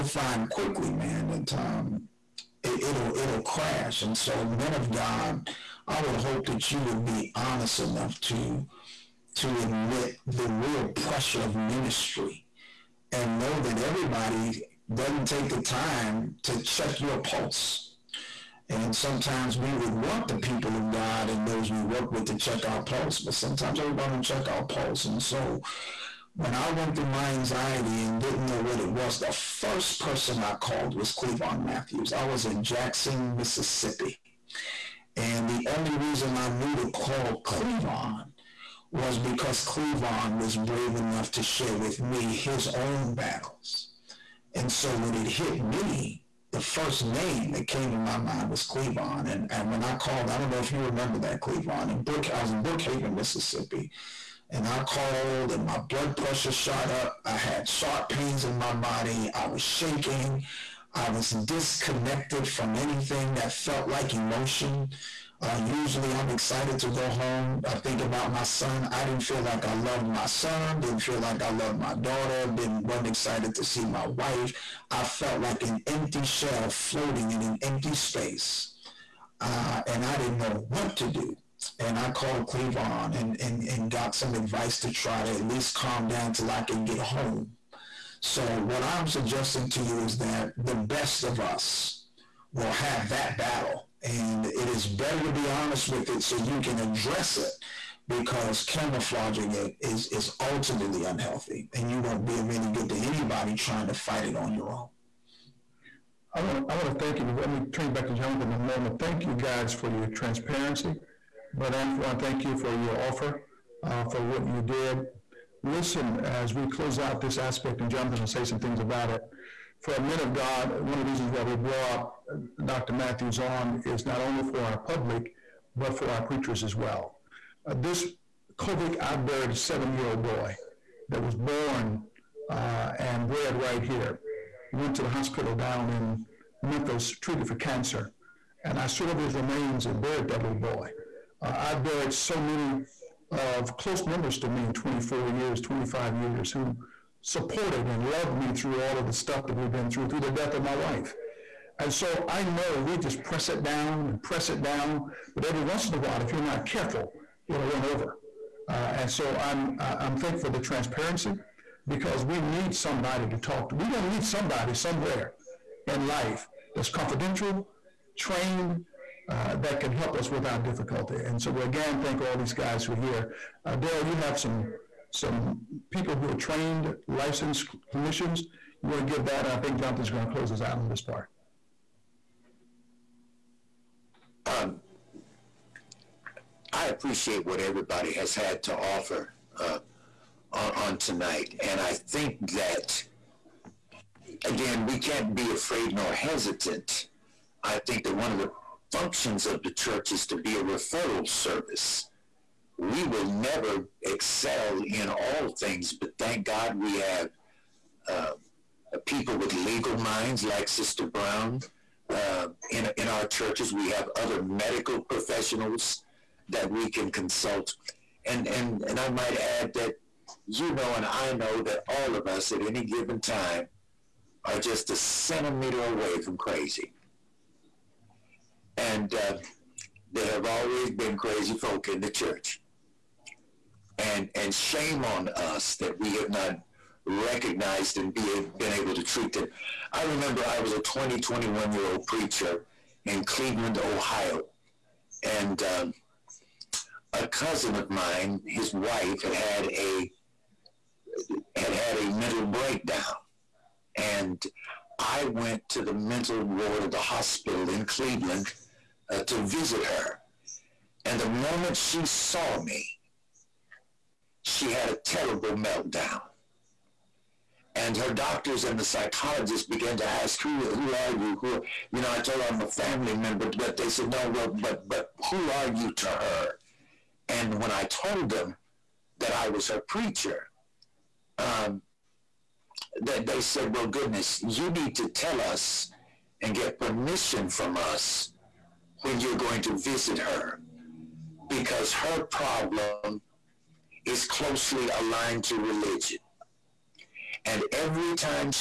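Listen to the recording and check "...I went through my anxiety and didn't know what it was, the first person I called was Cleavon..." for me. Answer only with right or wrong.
right.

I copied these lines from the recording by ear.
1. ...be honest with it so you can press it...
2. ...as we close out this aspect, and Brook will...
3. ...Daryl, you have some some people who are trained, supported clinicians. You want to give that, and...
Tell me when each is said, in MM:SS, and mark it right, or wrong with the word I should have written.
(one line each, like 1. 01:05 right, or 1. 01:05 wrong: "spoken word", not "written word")
1. 01:35 wrong: "address", not "press"
2. 01:56 wrong: "Jonathan", not "Brook"
3. 02:53 wrong: "licensed", not "supported".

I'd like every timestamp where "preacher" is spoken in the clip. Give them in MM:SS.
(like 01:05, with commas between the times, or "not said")
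02:06, 04:02, 04:39.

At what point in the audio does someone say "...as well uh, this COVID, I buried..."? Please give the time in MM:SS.
02:06.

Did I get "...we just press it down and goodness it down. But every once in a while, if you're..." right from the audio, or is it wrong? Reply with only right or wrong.
wrong.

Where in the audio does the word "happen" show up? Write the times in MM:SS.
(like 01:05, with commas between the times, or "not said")
not said.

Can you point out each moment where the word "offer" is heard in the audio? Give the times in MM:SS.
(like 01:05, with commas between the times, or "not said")
01:52, 03:08.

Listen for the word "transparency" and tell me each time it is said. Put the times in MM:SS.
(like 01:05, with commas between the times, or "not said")
01:50, 02:40.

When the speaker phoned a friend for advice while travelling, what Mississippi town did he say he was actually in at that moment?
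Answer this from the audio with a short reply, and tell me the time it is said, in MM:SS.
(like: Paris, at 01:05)
Brookhaven, at 00:52.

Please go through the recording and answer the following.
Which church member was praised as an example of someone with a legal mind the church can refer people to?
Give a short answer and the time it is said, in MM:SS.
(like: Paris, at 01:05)
Sister Brown, at 03:30.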